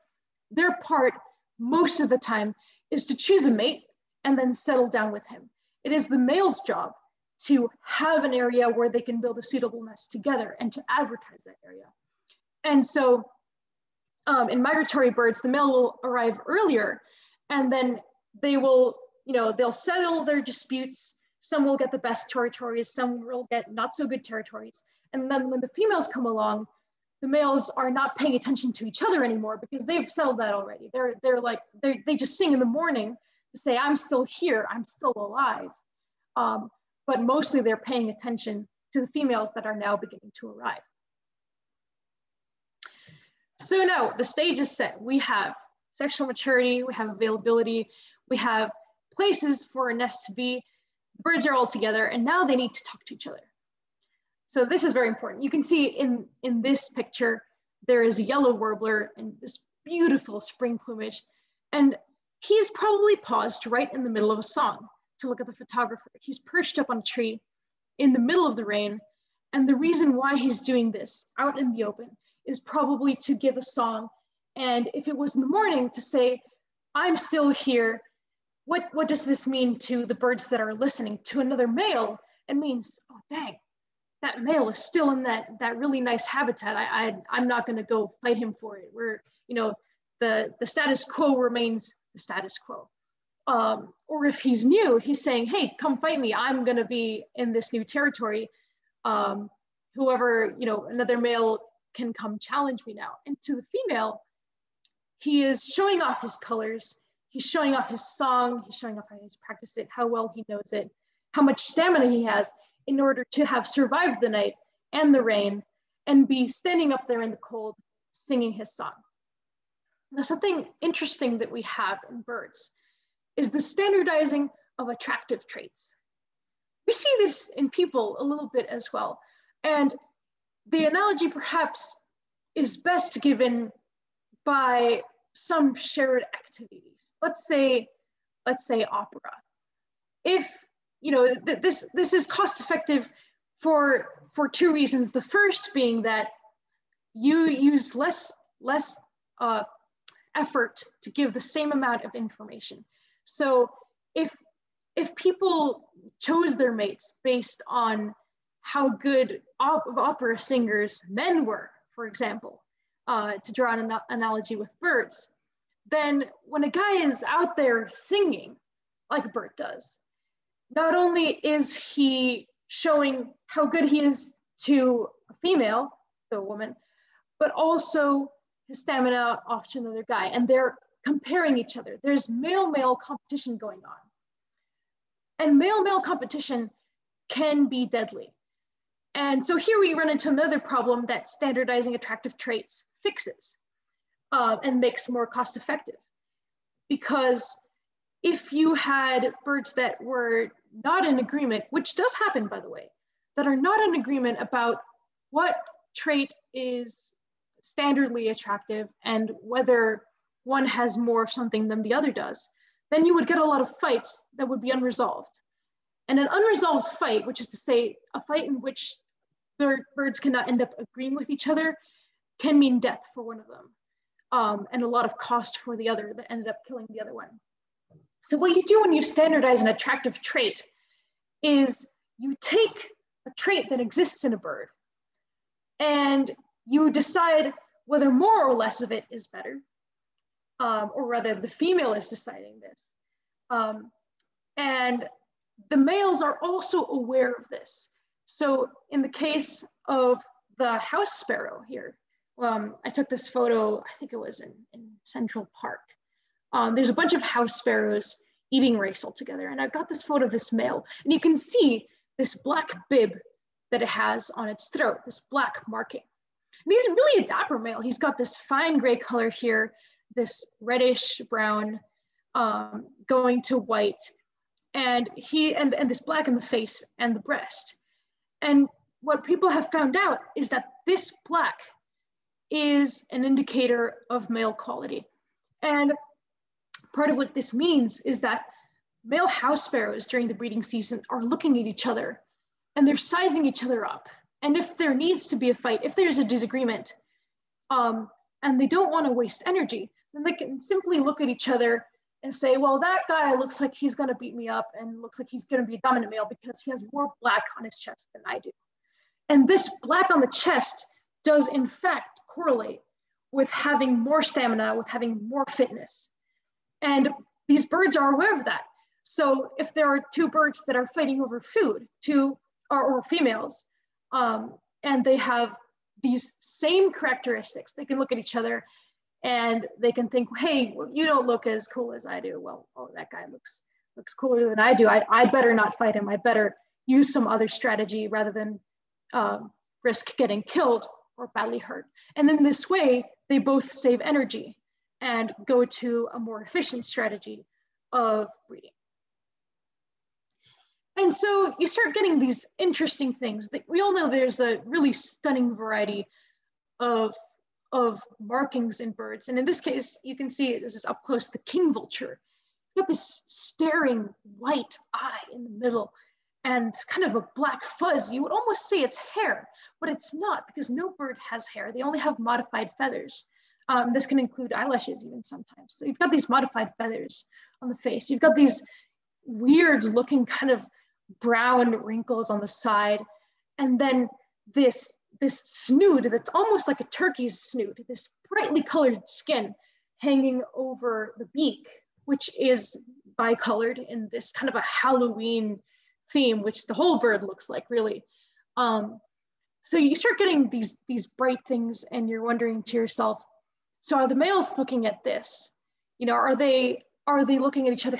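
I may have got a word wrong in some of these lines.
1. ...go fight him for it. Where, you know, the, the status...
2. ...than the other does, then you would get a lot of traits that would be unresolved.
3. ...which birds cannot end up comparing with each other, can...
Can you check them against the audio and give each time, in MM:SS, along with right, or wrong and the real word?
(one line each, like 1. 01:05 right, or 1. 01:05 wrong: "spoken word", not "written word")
1. 01:27 right
2. 03:31 wrong: "fights", not "traits"
3. 03:38 wrong: "agreeing", not "comparing".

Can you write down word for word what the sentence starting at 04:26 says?
And he's really a dapper male.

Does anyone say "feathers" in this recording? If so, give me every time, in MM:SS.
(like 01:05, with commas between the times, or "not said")
06:12, 06:16.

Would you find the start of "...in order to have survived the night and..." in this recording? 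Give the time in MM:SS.
01:52.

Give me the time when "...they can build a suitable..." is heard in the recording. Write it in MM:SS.
00:08.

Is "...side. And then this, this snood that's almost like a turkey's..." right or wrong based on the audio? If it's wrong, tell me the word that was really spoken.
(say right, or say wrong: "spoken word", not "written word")
right.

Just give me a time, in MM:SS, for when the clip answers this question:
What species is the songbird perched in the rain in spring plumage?
00:58.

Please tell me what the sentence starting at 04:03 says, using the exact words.
Um, and the males are also aware of this.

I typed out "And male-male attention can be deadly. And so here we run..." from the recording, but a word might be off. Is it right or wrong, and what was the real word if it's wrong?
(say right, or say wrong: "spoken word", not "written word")
wrong: "competition", not "attention".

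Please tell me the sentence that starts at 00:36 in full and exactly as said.
Um, but mostly they're paying attention to the females that are now beginning to arrive.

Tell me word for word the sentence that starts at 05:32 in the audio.
Well, oh, that guy looks looks cooler than I do.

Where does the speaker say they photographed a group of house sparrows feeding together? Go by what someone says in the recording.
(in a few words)
Central Park.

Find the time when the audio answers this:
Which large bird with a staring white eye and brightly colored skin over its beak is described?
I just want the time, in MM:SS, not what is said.
06:01.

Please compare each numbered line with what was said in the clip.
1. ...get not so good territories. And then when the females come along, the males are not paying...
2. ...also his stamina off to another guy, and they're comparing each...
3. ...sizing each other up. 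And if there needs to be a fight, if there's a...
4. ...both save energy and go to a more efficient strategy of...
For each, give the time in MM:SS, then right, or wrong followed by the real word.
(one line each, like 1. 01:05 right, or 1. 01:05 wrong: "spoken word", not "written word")
1. 00:23 right
2. 02:57 right
3. 04:52 right
4. 05:43 right.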